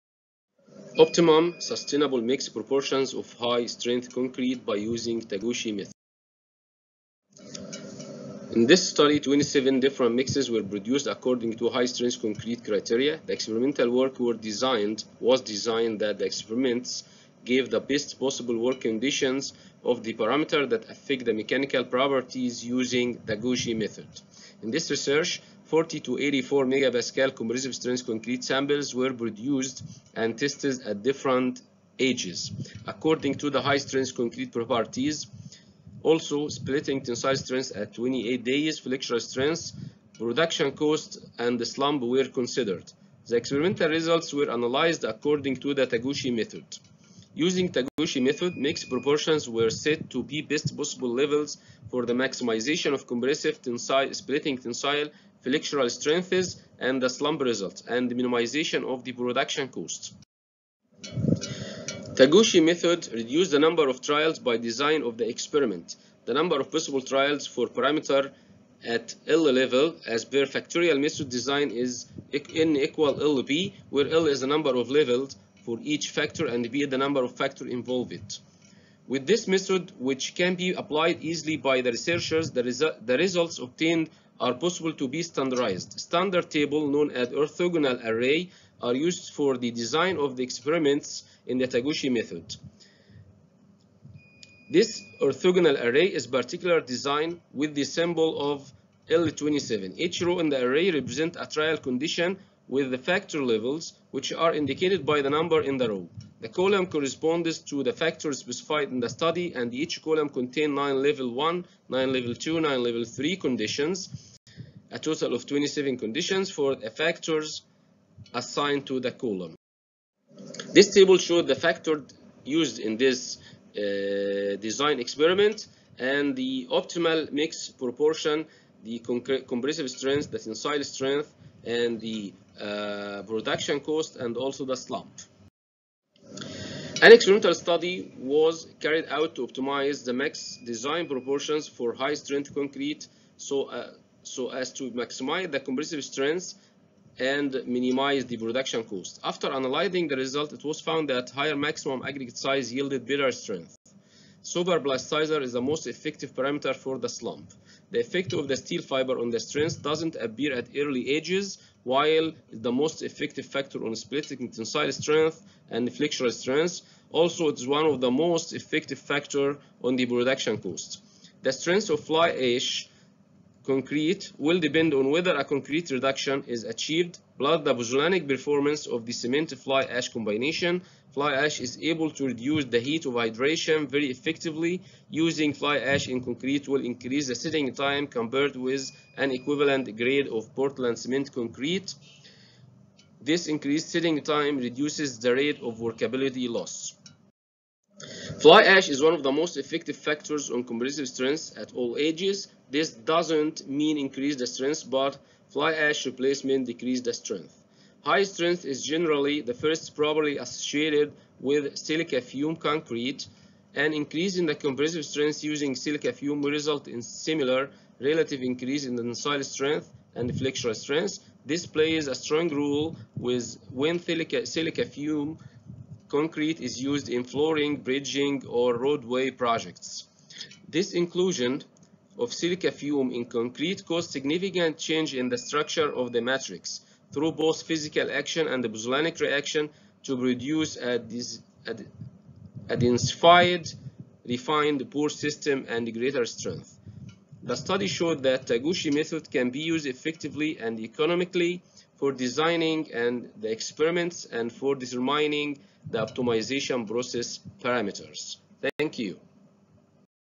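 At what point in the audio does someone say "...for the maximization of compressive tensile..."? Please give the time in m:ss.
0:51.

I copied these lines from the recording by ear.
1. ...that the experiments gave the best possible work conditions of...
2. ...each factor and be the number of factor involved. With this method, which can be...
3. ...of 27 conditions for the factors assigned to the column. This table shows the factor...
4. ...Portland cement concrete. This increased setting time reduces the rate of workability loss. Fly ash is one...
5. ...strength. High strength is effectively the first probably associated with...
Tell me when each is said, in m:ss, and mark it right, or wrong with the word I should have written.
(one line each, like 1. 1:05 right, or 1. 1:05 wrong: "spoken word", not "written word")
1. 0:16 right
2. 1:15 right
3. 1:55 right
4. 3:10 right
5. 3:27 wrong: "generally", not "effectively".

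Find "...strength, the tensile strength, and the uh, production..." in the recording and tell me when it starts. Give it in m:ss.
2:09.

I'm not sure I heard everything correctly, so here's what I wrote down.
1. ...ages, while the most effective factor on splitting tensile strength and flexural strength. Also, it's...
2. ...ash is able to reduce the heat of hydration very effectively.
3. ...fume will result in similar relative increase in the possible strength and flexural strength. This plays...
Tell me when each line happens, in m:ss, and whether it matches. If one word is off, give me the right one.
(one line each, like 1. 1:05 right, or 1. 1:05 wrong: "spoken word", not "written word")
1. 2:41 right
2. 3:01 right
3. 3:36 wrong: "tensile", not "possible".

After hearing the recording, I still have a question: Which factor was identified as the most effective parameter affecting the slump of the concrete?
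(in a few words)
Superplasticizer.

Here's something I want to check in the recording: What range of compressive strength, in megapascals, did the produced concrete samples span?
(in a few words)
40 to 84.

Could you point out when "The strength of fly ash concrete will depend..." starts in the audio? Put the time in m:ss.
2:51.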